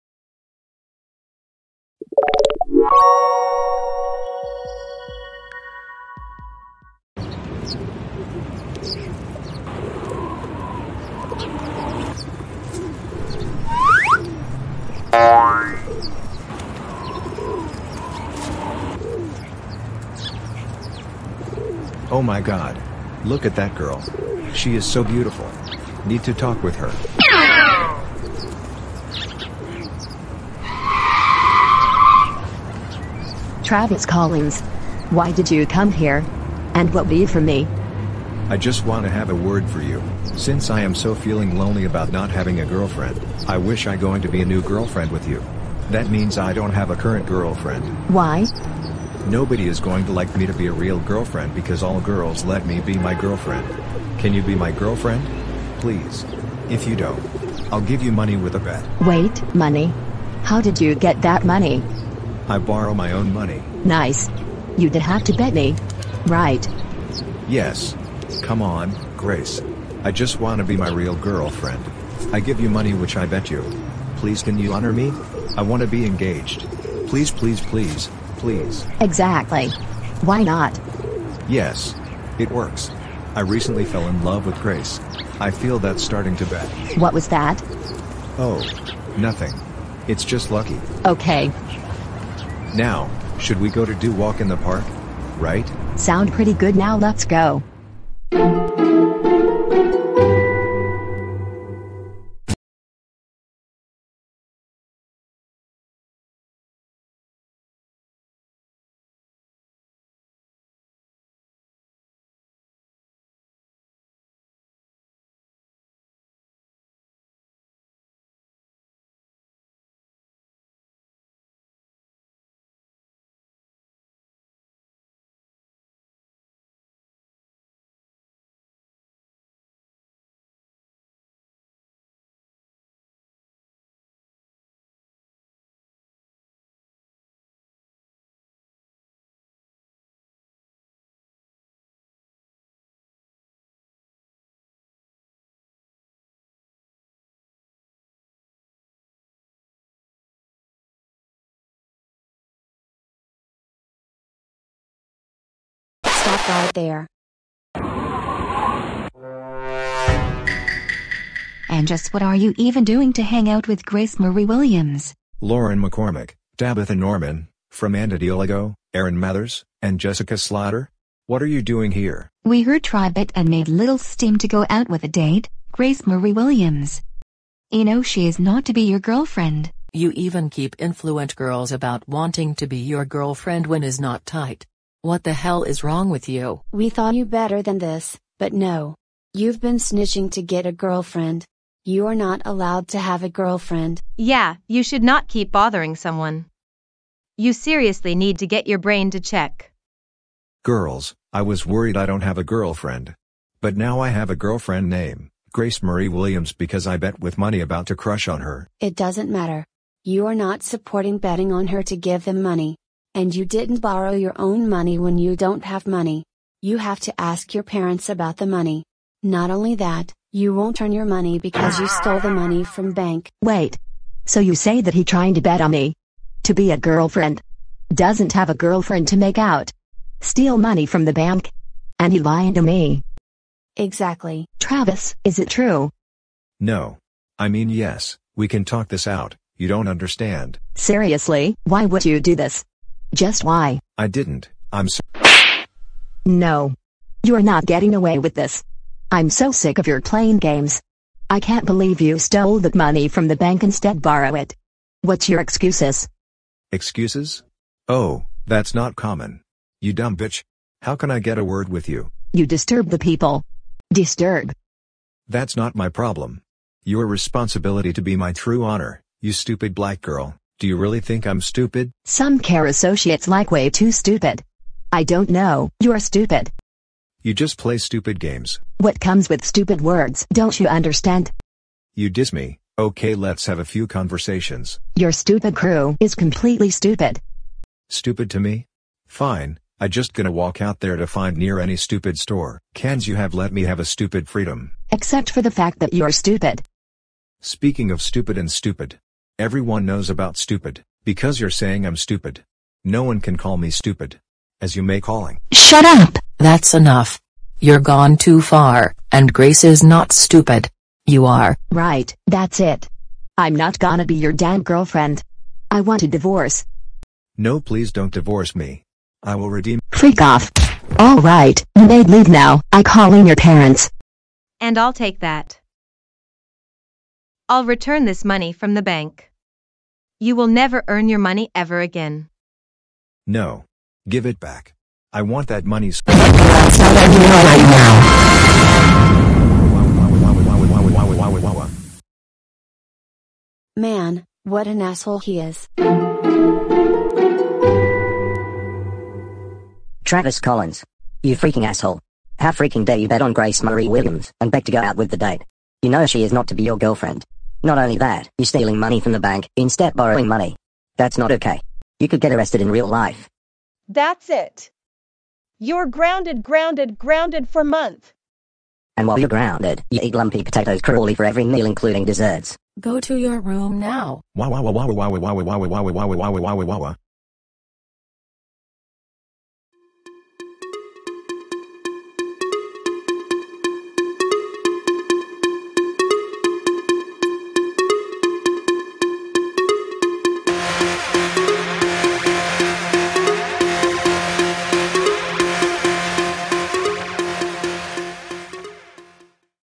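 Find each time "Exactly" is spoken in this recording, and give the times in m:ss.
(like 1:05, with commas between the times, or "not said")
1:19, 3:53.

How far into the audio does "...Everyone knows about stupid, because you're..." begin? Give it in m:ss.
4:59.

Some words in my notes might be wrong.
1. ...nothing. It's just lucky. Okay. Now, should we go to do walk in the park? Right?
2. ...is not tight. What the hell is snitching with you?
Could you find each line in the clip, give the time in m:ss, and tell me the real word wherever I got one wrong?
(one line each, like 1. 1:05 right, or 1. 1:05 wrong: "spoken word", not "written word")
1. 1:29 right
2. 3:03 wrong: "wrong", not "snitching".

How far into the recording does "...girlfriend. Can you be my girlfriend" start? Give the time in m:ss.
0:53.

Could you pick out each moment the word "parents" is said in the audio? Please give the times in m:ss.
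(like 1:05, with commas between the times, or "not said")
3:37, 5:23.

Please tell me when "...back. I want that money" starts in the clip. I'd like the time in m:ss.
5:34.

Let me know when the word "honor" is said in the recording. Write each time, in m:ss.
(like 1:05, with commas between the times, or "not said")
1:14, 4:28.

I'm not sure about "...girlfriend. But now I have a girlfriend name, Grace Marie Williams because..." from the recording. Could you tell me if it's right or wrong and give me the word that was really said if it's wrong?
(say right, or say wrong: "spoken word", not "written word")
right.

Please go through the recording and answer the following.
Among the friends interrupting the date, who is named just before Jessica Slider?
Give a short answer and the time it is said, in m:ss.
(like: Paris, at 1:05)
Erin Mathers, at 2:48.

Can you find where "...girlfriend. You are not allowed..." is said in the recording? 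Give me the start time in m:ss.
3:10.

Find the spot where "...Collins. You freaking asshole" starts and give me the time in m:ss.
5:50.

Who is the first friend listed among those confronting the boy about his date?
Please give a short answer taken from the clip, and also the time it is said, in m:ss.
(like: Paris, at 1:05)
Lauren McCormick, at 2:45.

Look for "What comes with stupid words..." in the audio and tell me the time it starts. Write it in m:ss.
4:38.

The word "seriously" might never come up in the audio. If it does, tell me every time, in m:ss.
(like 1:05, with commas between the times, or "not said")
3:17, 4:00.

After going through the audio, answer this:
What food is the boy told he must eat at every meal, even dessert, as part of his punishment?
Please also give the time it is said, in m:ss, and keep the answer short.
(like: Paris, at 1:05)
lumpy potatoes, at 6:10.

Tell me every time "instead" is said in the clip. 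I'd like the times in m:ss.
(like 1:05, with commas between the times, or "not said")
4:13, 5:59.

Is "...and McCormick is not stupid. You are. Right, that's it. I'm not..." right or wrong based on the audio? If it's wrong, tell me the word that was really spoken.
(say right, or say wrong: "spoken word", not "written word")
wrong: "Grace", not "McCormick".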